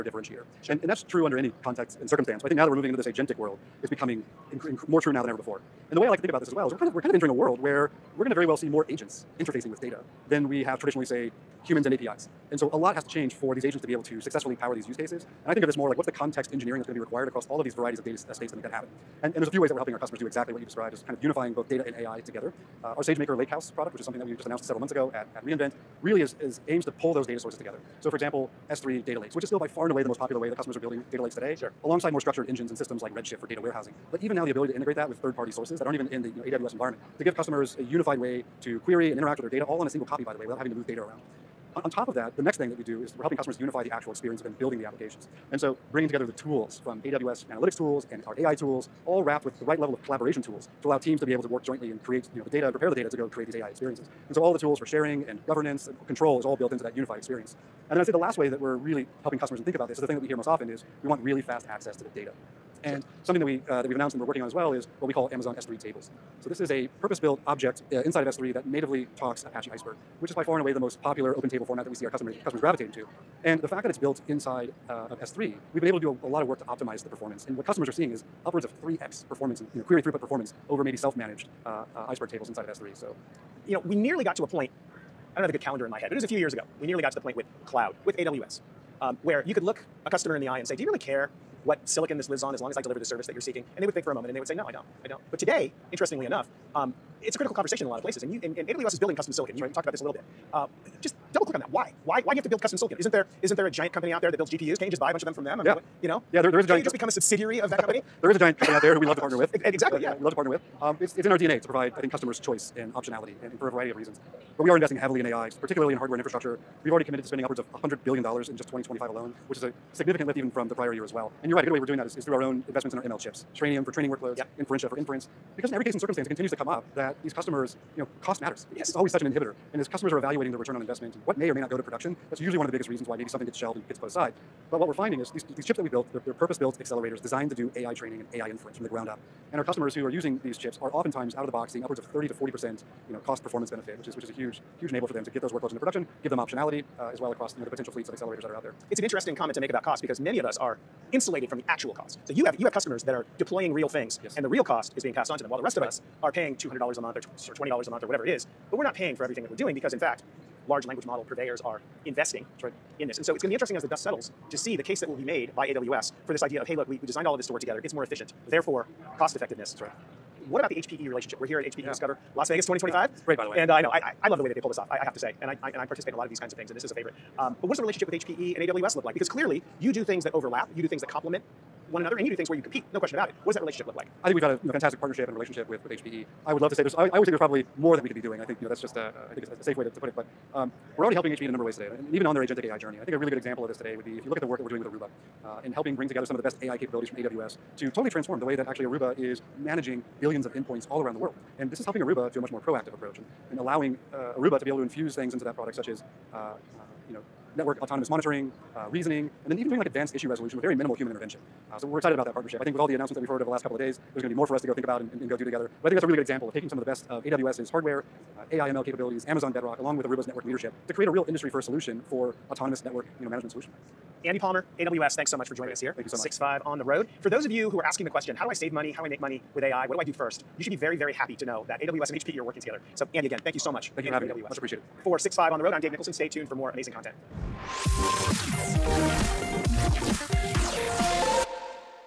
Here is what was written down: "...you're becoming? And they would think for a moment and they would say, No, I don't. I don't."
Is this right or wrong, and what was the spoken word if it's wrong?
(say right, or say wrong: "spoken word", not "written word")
wrong: "seeking", not "becoming".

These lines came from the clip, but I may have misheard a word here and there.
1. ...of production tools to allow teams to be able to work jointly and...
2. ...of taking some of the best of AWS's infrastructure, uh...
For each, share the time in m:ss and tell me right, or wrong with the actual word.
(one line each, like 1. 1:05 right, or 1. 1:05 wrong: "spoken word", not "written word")
1. 0:49 wrong: "collaboration", not "production"
2. 3:36 wrong: "hardware", not "infrastructure".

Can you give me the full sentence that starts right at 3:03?
What does that relationship look like?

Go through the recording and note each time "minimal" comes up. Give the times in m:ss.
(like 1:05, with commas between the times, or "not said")
3:30.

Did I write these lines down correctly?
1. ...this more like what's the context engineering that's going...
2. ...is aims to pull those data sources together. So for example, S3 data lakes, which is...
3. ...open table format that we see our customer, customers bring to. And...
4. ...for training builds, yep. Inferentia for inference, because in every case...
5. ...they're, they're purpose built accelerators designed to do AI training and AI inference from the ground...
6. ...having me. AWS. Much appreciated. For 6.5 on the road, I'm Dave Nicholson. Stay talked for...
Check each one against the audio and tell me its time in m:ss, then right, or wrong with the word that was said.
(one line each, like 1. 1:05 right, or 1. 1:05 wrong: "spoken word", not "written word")
1. 0:15 right
2. 0:26 right
3. 1:11 wrong: "gravitating", not "bring"
4. 2:03 wrong: "workloads", not "builds"
5. 2:16 right
6. 3:54 wrong: "tuned", not "talked".